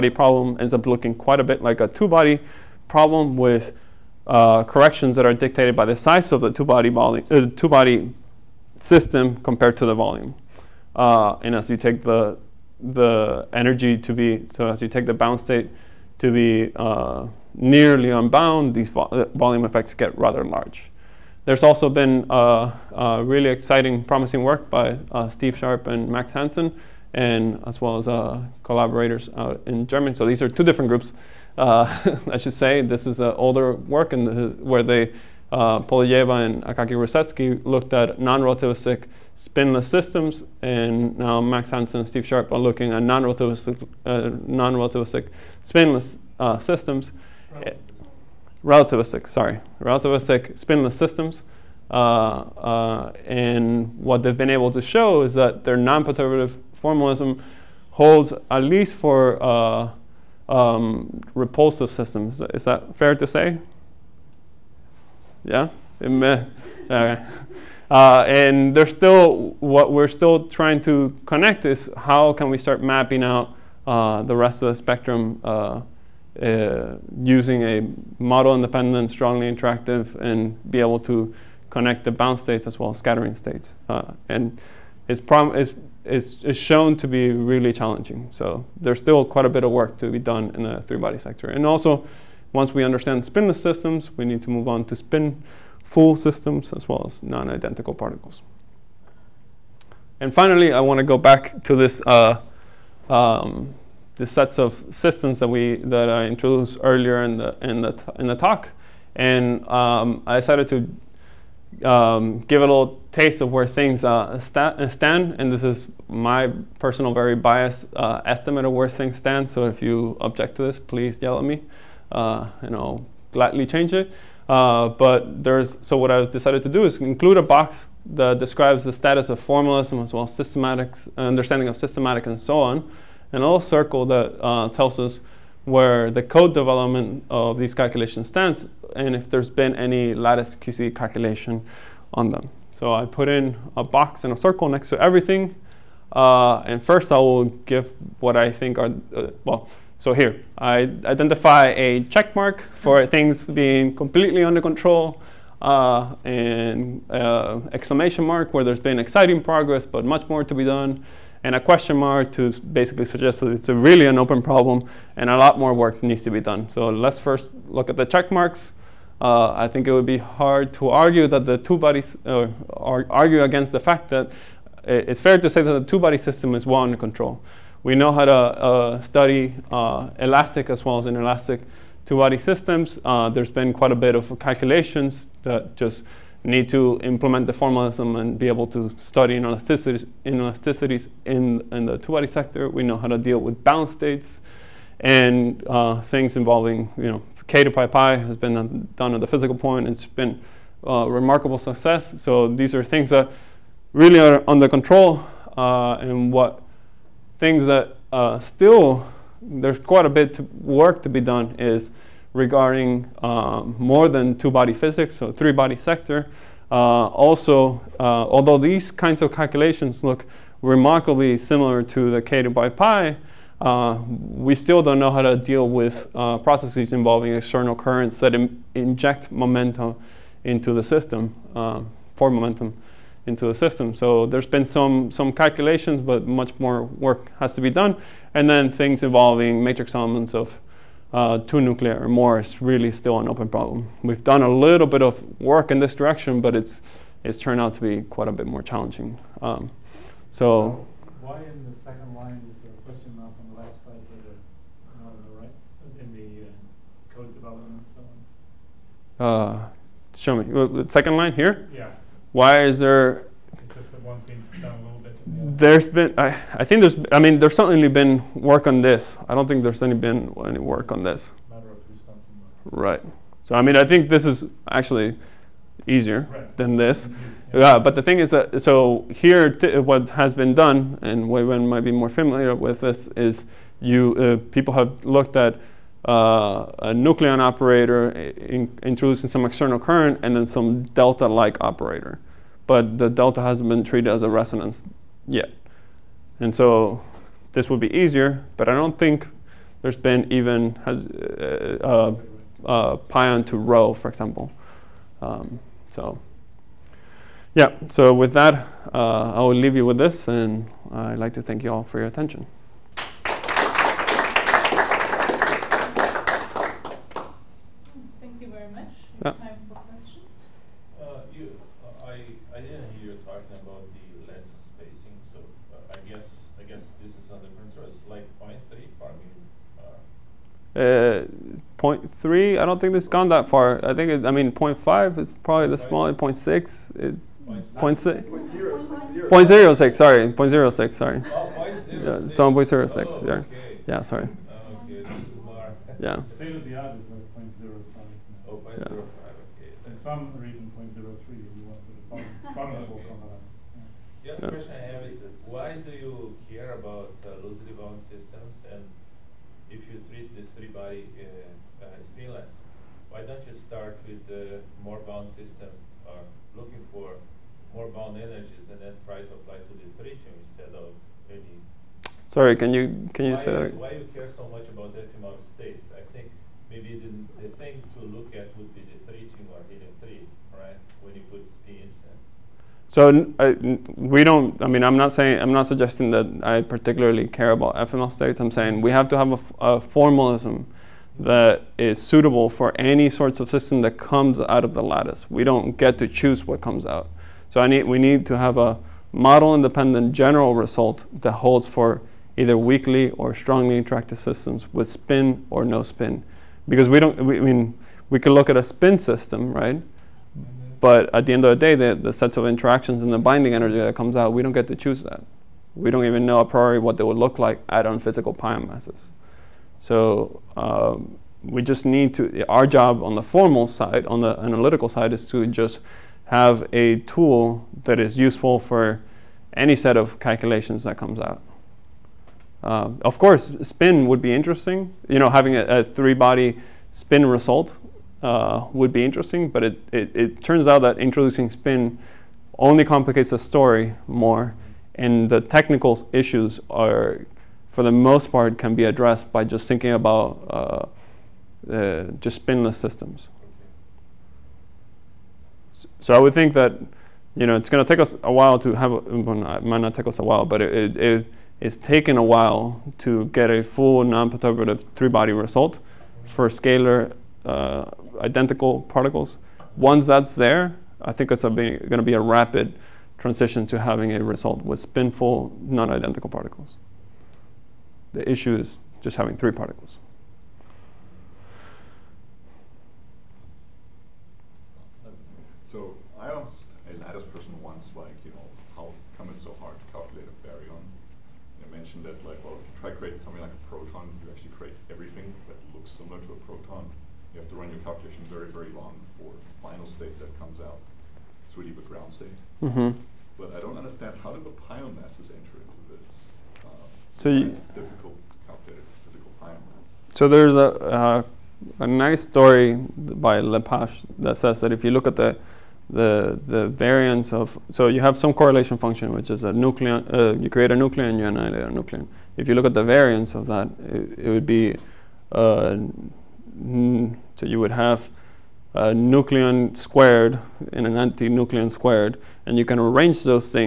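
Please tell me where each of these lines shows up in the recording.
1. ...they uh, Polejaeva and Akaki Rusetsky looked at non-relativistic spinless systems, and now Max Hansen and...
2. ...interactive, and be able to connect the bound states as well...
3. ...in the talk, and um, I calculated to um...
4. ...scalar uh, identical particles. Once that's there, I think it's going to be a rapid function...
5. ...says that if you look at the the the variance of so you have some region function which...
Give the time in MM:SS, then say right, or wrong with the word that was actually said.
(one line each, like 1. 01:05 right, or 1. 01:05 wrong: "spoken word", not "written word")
1. 00:34 right
2. 01:19 right
3. 01:48 wrong: "decided", not "calculated"
4. 07:46 wrong: "transition", not "function"
5. 08:34 wrong: "correlation", not "region".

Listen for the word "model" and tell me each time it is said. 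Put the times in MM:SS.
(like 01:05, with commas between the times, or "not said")
01:18, 06:39.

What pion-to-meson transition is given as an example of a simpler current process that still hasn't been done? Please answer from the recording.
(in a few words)
pion to rho.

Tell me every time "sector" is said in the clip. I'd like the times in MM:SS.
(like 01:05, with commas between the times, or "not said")
01:31, 03:12, 03:35.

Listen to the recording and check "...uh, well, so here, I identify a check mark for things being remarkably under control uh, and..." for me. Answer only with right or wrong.
wrong.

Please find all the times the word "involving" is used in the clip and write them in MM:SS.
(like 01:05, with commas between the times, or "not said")
03:16, 03:46, 03:59.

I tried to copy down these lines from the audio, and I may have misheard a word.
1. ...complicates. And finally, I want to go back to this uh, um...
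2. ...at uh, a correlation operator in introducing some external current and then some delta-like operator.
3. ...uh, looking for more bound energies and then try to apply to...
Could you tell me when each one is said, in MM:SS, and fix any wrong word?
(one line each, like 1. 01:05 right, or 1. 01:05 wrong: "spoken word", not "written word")
1. 01:37 wrong: "particles", not "complicates"
2. 04:45 wrong: "nucleon", not "correlation"
3. 06:06 right.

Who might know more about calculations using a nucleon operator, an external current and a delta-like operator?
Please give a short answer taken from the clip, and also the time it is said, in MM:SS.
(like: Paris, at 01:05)
Huey-Wen, at 04:41.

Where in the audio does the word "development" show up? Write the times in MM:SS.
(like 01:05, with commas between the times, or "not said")
02:16, 04:17.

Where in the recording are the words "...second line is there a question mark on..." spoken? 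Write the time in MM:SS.
04:11.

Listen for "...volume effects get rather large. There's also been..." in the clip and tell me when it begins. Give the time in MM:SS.
00:19.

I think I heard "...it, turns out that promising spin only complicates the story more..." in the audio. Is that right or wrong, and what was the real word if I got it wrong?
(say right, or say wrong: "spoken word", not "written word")
wrong: "introducing", not "promising".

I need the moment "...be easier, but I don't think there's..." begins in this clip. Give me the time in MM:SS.
04:57.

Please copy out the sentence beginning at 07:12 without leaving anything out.
Uh, of course, spin would be interesting.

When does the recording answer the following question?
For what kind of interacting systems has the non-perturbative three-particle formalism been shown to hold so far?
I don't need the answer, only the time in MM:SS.
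01:01.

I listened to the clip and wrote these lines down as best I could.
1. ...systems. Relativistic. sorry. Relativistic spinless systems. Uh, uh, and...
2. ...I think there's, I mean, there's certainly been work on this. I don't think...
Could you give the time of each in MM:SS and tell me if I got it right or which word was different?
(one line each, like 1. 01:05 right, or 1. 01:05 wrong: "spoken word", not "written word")
1. 00:46 right
2. 04:26 right.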